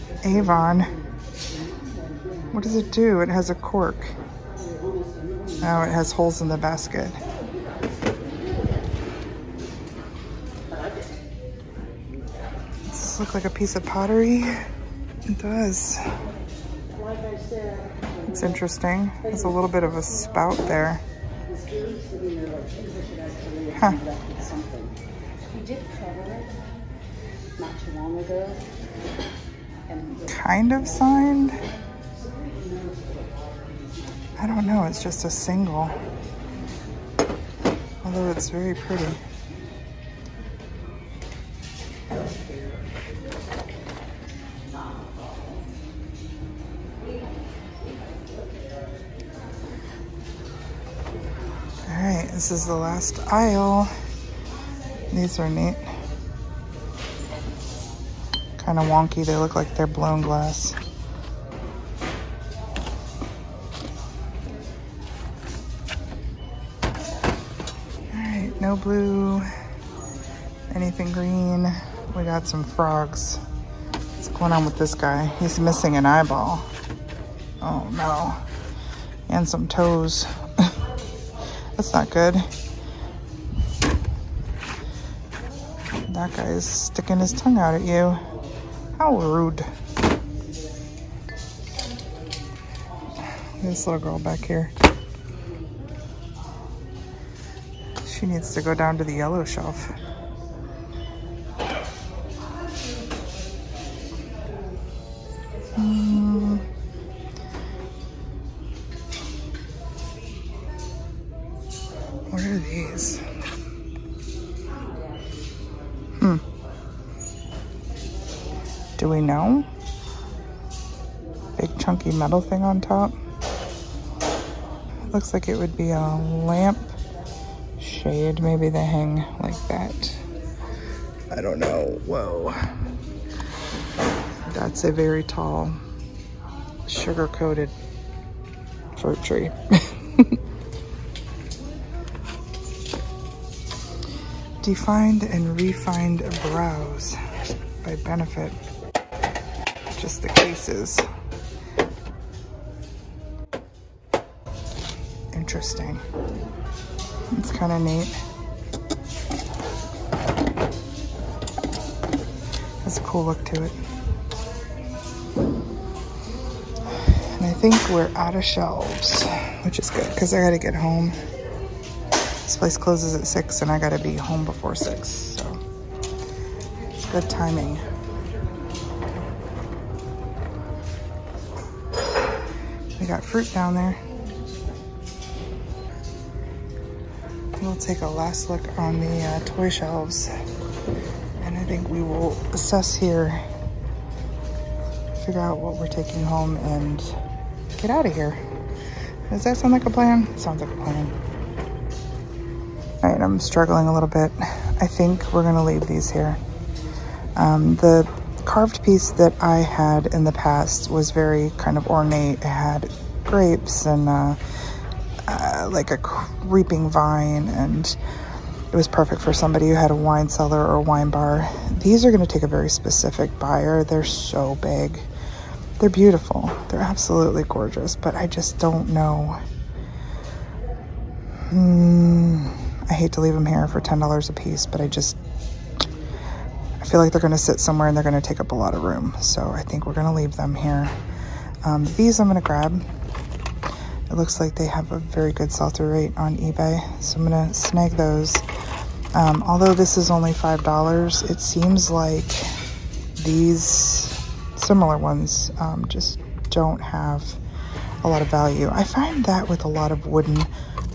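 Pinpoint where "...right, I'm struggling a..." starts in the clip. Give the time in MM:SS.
03:23.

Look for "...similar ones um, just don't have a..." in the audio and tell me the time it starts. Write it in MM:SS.
04:14.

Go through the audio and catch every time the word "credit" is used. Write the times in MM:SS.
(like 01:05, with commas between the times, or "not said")
not said.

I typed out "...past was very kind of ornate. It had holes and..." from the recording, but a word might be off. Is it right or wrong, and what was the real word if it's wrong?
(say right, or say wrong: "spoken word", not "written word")
wrong: "grapes", not "holes".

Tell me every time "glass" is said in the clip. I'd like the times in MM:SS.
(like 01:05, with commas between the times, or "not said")
01:00.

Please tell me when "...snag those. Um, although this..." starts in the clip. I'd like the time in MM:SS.
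04:07.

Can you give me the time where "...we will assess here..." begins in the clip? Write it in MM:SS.
03:11.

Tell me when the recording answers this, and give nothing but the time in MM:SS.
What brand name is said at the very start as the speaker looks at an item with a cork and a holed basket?
00:00.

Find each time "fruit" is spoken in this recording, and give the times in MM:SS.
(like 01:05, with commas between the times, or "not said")
02:18, 03:03.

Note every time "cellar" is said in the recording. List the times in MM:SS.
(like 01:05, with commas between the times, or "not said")
03:40.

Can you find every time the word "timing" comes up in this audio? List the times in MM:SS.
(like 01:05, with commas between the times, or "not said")
02:57.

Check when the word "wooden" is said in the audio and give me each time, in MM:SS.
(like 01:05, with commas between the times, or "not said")
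04:20.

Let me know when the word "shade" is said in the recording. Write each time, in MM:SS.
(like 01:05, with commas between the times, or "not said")
02:07.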